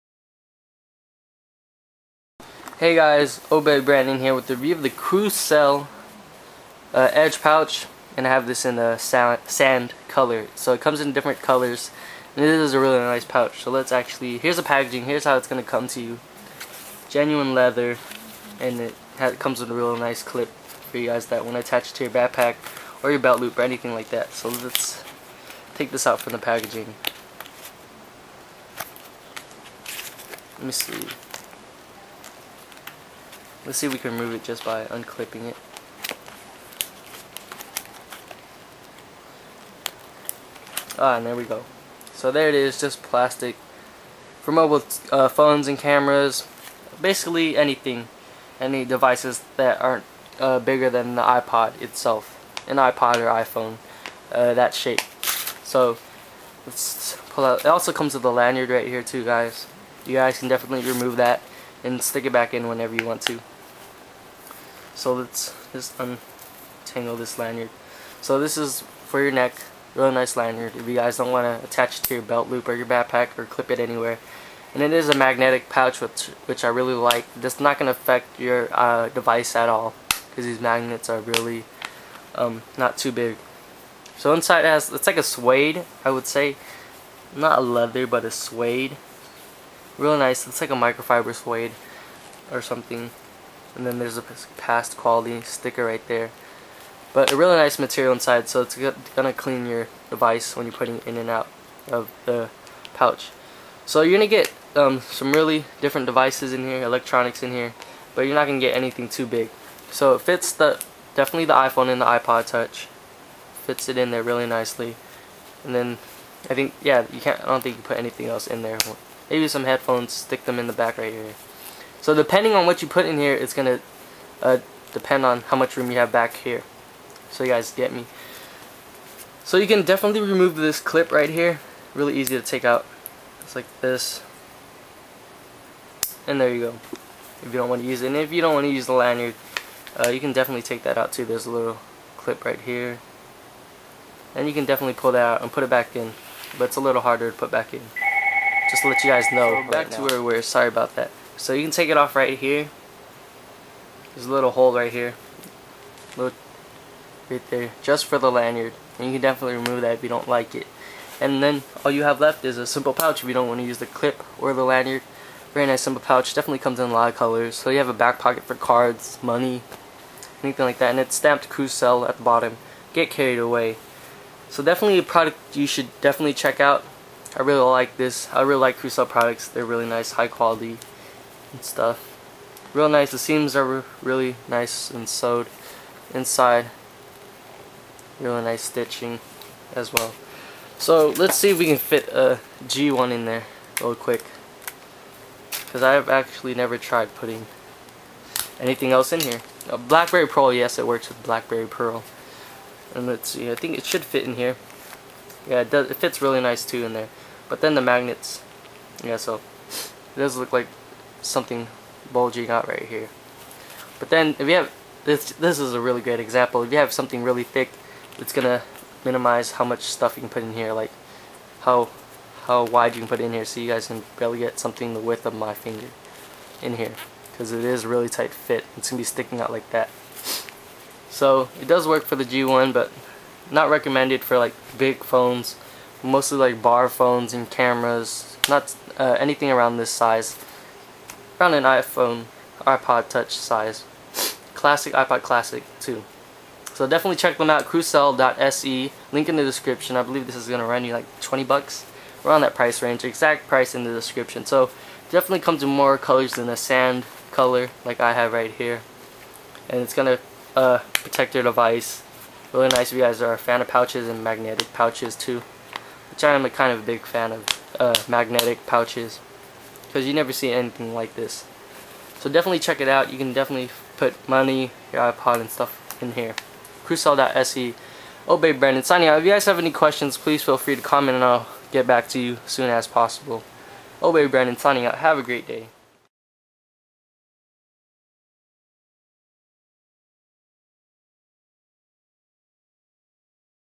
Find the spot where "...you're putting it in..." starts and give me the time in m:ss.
1:40.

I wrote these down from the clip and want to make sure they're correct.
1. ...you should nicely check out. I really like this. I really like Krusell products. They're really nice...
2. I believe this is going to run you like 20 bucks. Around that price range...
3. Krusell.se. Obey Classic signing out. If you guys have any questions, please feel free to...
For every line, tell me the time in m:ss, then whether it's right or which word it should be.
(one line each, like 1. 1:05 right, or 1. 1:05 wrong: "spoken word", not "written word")
1. 2:55 wrong: "definitely", not "nicely"
2. 4:09 right
3. 4:36 wrong: "Brandon", not "Classic".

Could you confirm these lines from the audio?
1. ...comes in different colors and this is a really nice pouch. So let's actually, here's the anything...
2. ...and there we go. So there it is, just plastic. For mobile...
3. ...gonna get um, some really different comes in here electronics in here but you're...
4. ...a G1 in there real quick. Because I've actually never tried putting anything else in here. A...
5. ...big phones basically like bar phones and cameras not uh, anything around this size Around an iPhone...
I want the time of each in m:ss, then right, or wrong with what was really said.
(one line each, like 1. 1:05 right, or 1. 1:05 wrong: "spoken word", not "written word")
1. 0:10 wrong: "packaging", not "anything"
2. 0:41 right
3. 1:44 wrong: "devices", not "comes"
4. 3:12 right
5. 3:54 wrong: "mostly", not "basically".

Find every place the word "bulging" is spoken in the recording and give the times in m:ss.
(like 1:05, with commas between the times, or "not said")
3:32.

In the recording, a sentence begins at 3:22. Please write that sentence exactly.
And let's see, I think it should fit in here.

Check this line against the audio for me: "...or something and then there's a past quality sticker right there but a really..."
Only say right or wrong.
right.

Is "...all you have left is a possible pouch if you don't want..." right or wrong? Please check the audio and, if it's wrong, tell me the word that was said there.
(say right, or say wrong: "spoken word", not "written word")
wrong: "simple", not "possible".